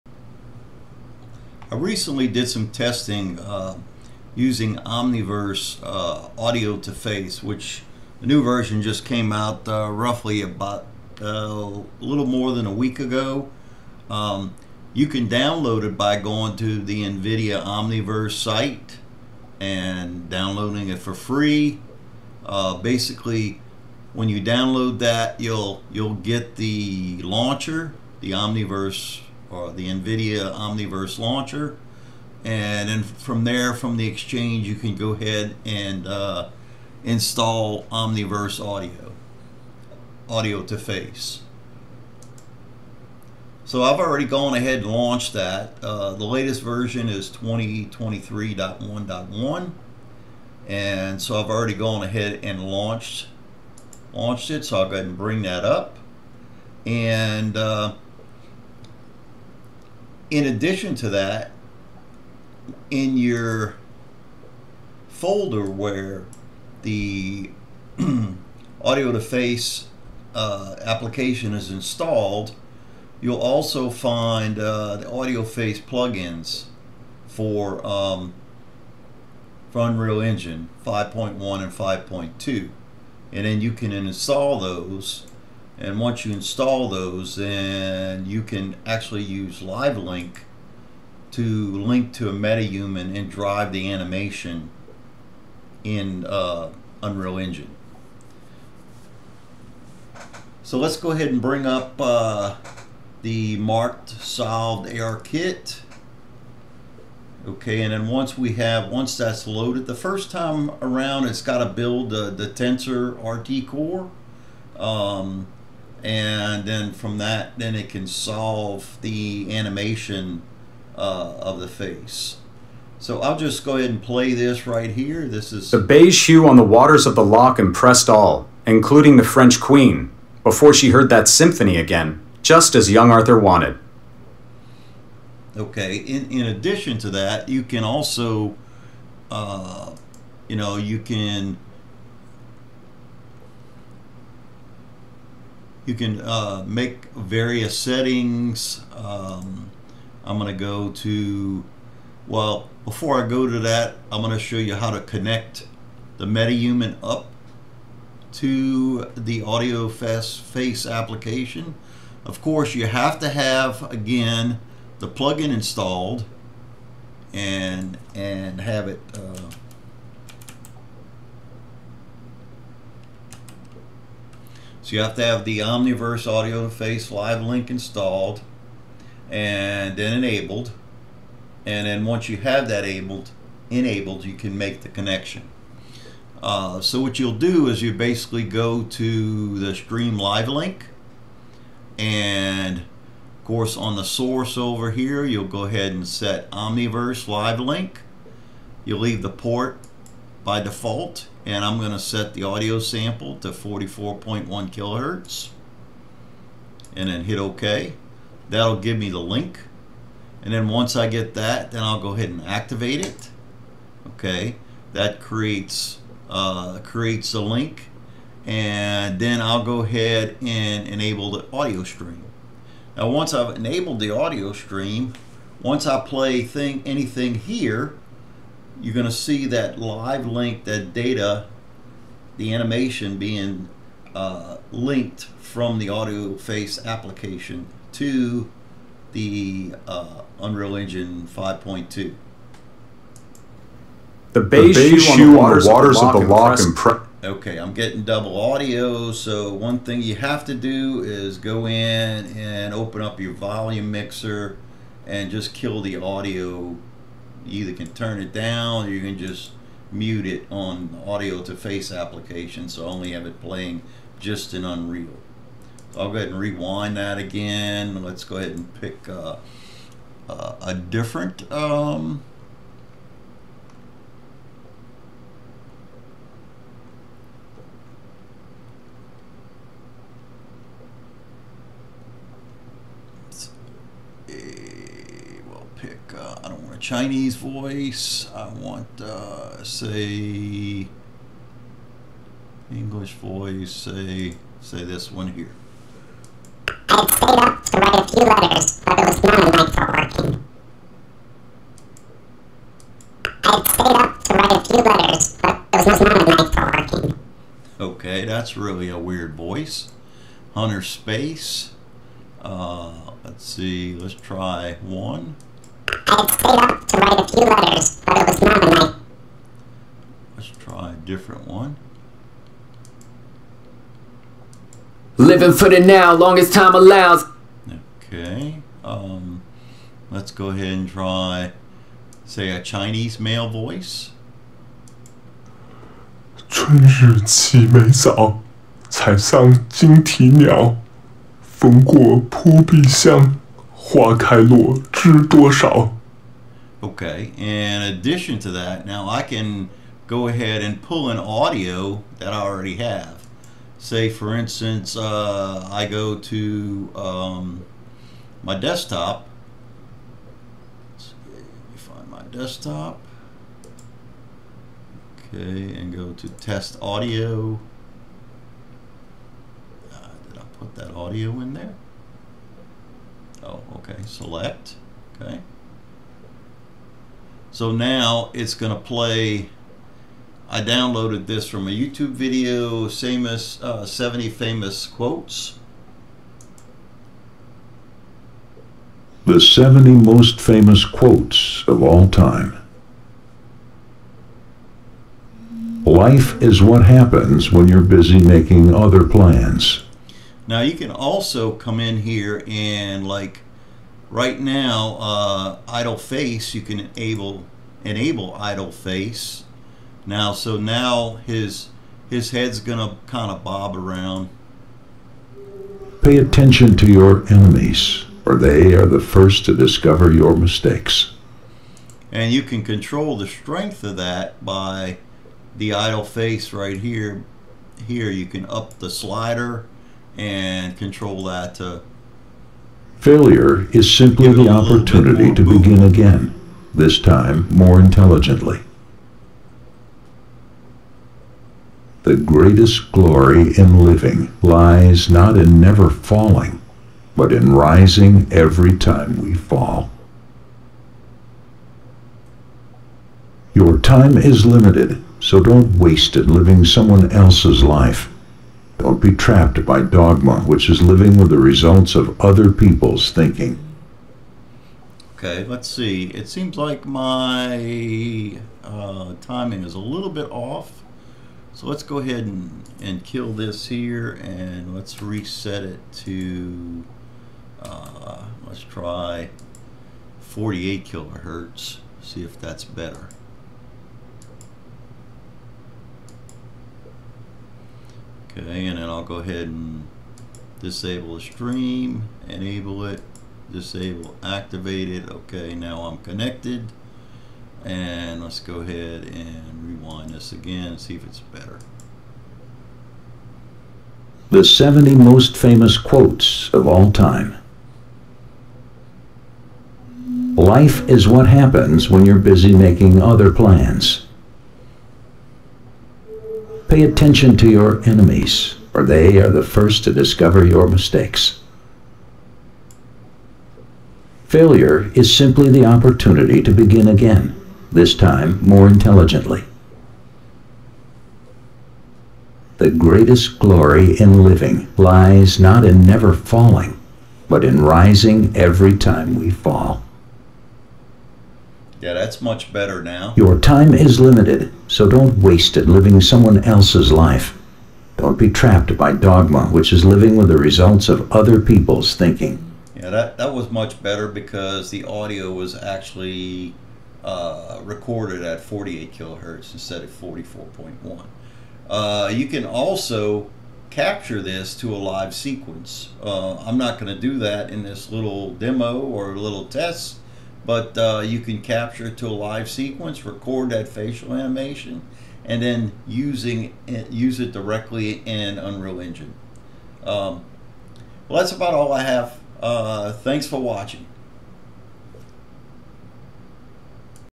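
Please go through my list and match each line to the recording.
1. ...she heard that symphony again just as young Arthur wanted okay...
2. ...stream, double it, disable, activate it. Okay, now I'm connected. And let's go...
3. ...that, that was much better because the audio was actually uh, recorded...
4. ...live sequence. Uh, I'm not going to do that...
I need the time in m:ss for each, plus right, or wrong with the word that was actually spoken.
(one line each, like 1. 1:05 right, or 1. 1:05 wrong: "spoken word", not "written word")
1. 2:10 right
2. 8:11 wrong: "enable", not "double"
3. 9:12 right
4. 9:24 right.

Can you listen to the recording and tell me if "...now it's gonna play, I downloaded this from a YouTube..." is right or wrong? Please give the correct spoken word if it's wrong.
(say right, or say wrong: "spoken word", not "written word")
right.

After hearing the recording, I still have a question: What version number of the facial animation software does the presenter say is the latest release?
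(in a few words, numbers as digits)
2023.1.1.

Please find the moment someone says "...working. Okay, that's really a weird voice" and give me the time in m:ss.
5:06.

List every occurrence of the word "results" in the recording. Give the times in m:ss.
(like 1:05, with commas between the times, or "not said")
7:41, 9:10.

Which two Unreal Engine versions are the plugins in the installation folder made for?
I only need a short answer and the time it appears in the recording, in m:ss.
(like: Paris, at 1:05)
5.1 and 5.2, at 1:20.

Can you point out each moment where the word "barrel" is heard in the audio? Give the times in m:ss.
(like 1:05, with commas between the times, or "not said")
not said.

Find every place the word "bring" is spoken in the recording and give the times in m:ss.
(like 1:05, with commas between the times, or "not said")
0:55, 1:41.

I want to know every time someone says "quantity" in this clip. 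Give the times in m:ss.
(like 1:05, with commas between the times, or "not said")
not said.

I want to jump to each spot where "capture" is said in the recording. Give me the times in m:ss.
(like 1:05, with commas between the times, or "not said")
9:23, 9:31.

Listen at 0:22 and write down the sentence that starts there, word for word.
Uh, basically, when you download that, you'll you'll get the launcher, the Omniverse or uh, the NVIDIA Omniverse launcher.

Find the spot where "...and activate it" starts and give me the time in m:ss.
3:32.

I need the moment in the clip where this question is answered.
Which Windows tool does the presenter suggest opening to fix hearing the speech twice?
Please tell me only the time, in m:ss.
4:13.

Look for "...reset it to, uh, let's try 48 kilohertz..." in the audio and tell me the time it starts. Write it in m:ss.
7:54.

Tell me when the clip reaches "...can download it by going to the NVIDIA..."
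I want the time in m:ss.
0:15.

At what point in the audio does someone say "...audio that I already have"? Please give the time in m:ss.
5:51.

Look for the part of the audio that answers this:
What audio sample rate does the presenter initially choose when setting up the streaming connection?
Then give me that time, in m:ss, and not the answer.
3:23.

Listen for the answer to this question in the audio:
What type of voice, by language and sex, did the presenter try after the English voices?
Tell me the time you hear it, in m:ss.
5:32.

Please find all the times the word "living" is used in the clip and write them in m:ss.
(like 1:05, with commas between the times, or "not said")
5:25, 7:23, 7:36, 7:40, 8:54, 9:05, 9:09.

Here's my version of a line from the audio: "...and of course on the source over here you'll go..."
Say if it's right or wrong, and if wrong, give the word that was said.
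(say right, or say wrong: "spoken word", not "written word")
right.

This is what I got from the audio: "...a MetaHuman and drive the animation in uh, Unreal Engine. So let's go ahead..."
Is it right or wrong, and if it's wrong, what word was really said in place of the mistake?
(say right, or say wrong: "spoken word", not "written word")
right.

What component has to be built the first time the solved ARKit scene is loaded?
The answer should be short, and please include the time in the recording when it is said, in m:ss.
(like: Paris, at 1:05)
TensorRT core, at 1:52.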